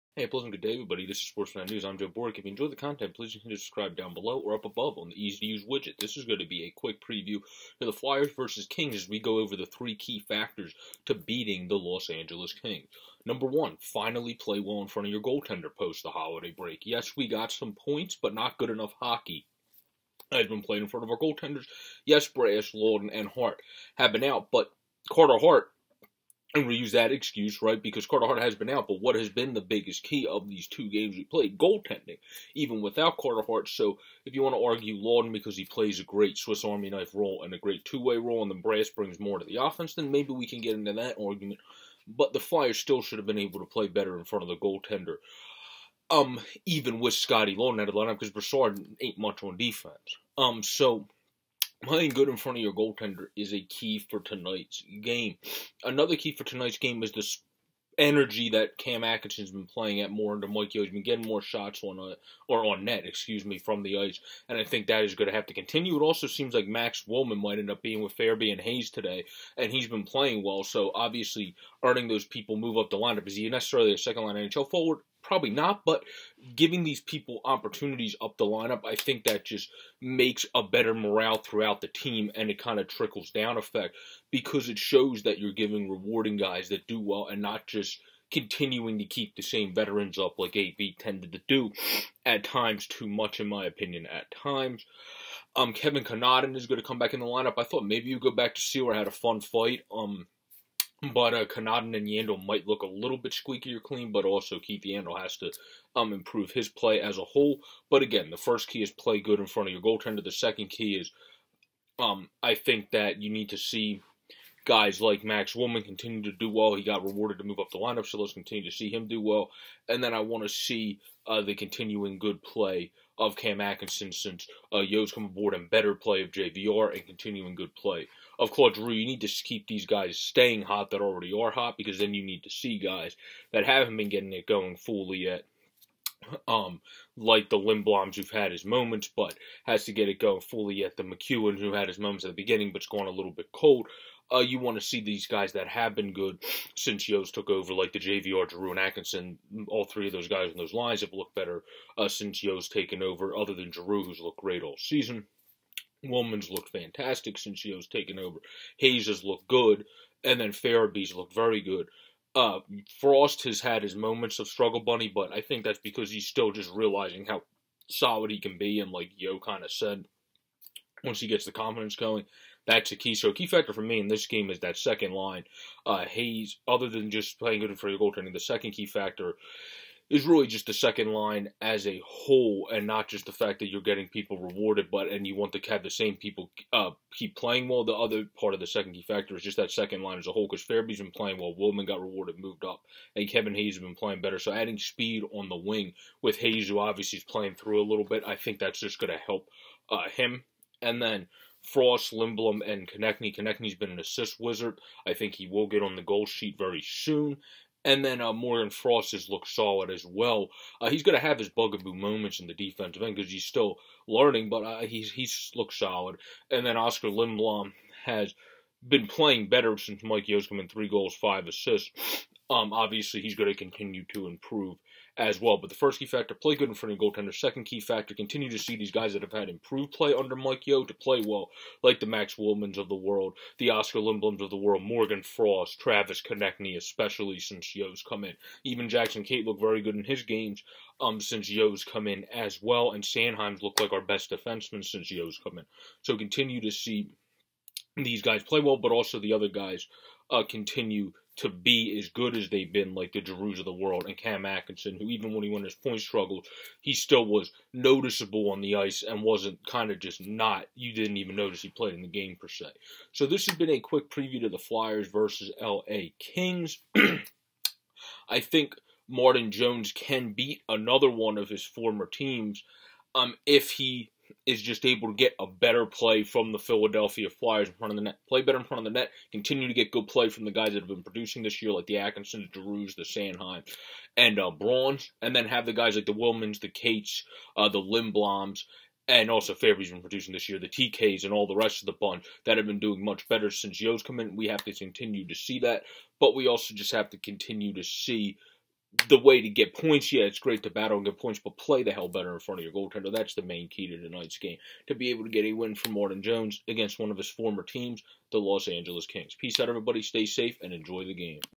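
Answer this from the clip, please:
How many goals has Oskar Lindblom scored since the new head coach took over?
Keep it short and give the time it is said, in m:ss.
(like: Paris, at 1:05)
3, at 3:40.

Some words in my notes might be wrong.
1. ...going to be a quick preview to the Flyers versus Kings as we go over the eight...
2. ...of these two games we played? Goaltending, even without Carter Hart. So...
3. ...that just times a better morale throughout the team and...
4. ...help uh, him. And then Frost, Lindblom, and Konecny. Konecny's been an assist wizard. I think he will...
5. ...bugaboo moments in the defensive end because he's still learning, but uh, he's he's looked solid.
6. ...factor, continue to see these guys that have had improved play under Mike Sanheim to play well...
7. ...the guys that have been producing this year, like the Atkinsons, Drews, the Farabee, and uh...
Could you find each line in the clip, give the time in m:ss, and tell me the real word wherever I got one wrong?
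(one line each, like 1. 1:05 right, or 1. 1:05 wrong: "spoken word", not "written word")
1. 0:06 wrong: "three", not "eight"
2. 0:30 right
3. 1:19 wrong: "makes", not "times"
4. 3:19 right
5. 3:31 right
6. 3:47 wrong: "Yeo", not "Sanheim"
7. 4:40 wrong: "Sanheim", not "Farabee".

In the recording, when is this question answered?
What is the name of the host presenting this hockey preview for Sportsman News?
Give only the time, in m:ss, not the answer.
0:01.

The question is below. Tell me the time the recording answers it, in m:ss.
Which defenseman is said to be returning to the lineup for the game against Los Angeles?
1:35.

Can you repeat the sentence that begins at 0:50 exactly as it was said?
Um, so Playing good in front of your goaltender is a key for tonight's game.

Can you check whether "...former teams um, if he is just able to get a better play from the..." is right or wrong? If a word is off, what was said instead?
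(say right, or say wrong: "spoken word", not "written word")
right.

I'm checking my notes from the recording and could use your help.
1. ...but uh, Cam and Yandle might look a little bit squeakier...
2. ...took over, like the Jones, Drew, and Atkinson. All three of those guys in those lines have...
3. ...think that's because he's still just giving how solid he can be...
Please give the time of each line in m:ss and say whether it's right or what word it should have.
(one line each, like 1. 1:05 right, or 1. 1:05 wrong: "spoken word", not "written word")
1. 1:41 wrong: "Kanada", not "Cam"
2. 2:27 wrong: "JVR", not "Jones"
3. 2:45 wrong: "realizing", not "giving".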